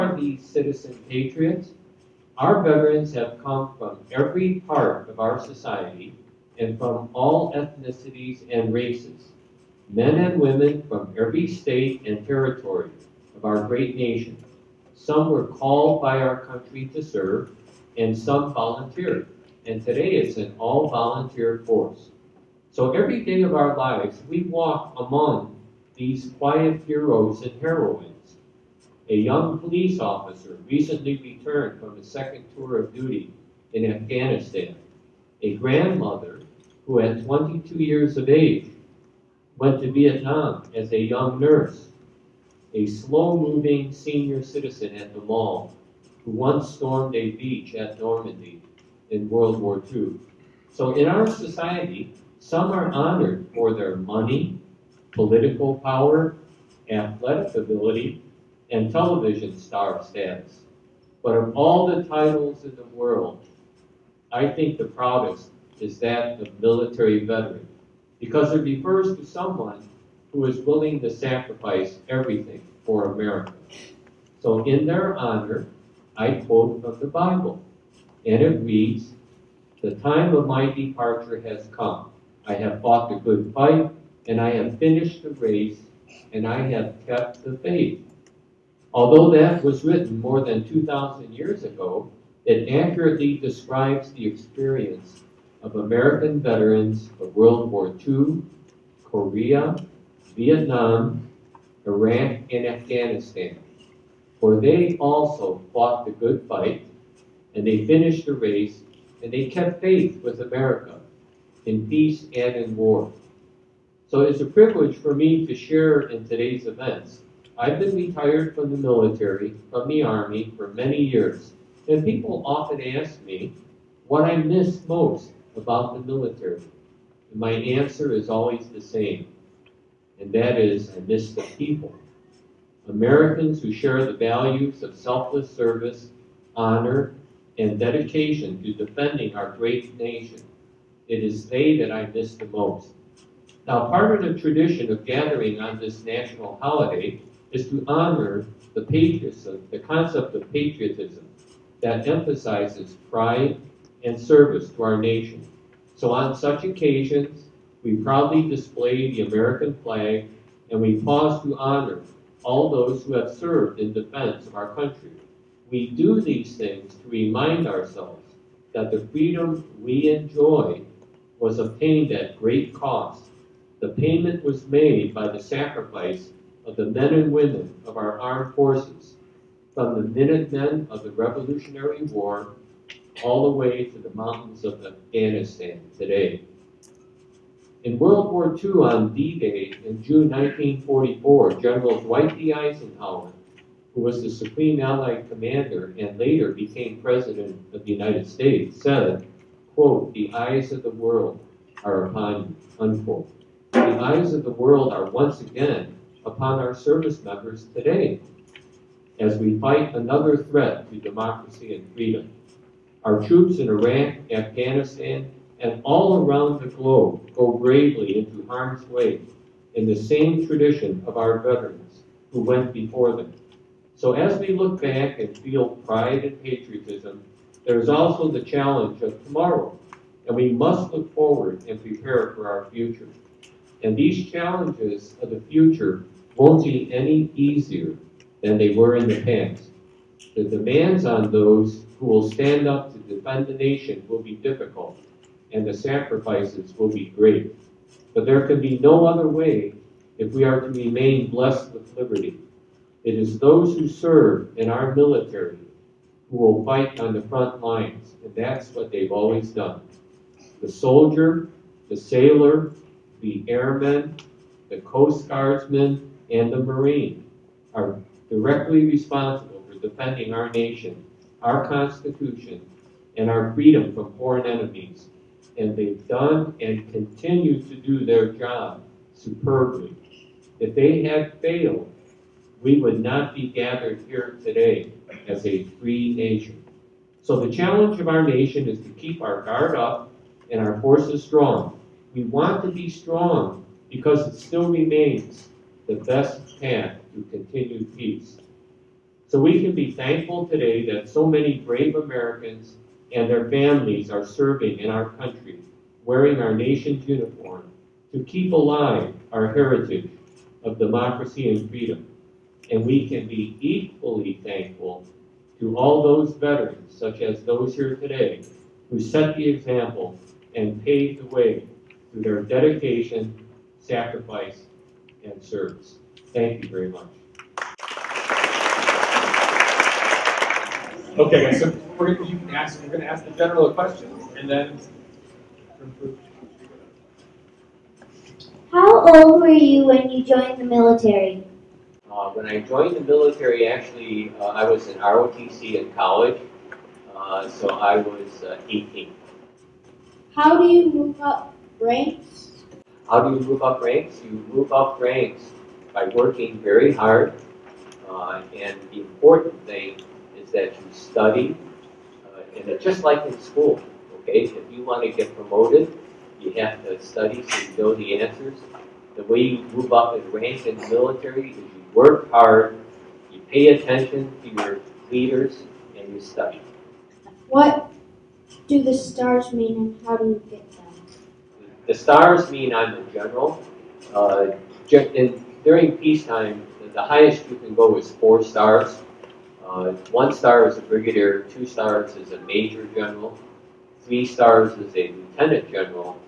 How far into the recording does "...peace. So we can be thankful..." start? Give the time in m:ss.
4:57.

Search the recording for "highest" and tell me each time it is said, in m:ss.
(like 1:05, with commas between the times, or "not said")
6:27.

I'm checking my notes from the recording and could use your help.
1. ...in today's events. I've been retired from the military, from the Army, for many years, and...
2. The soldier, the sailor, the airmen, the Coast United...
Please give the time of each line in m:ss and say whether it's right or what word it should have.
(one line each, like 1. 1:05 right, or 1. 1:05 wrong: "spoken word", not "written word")
1. 1:56 right
2. 4:20 wrong: "Guardsmen", not "United".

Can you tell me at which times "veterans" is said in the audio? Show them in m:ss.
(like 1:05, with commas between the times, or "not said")
0:02, 1:07, 1:36, 3:41, 5:16.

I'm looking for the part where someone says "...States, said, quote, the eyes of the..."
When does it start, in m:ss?
3:18.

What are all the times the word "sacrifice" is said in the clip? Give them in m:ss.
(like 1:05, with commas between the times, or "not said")
1:11, 2:55, 4:05, 5:23.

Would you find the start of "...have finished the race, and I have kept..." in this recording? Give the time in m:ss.
1:24.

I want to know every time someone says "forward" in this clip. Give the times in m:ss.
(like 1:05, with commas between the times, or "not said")
3:51.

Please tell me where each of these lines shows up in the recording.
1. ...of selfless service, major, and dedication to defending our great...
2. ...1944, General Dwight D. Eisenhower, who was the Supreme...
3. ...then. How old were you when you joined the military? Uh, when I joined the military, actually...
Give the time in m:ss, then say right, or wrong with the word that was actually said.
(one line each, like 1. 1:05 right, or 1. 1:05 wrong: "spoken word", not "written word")
1. 2:14 wrong: "honor", not "major"
2. 3:10 right
3. 5:34 right.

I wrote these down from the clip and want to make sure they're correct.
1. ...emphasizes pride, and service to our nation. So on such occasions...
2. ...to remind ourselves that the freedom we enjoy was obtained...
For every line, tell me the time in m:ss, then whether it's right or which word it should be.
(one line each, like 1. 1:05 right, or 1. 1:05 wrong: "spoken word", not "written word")
1. 2:32 right
2. 2:46 right.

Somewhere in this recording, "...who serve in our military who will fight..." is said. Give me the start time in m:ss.
4:13.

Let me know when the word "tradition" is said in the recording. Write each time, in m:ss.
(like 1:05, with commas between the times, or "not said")
2:24, 3:40.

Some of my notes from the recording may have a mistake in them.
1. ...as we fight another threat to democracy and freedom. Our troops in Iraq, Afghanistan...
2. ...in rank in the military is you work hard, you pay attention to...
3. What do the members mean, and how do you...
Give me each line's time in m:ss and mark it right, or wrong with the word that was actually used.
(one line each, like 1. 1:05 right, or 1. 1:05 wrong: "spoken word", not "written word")
1. 3:29 right
2. 6:10 right
3. 6:17 wrong: "stars", not "members".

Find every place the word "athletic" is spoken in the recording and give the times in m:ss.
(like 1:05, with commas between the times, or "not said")
0:56.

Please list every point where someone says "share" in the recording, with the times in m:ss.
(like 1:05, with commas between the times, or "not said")
1:55, 2:13.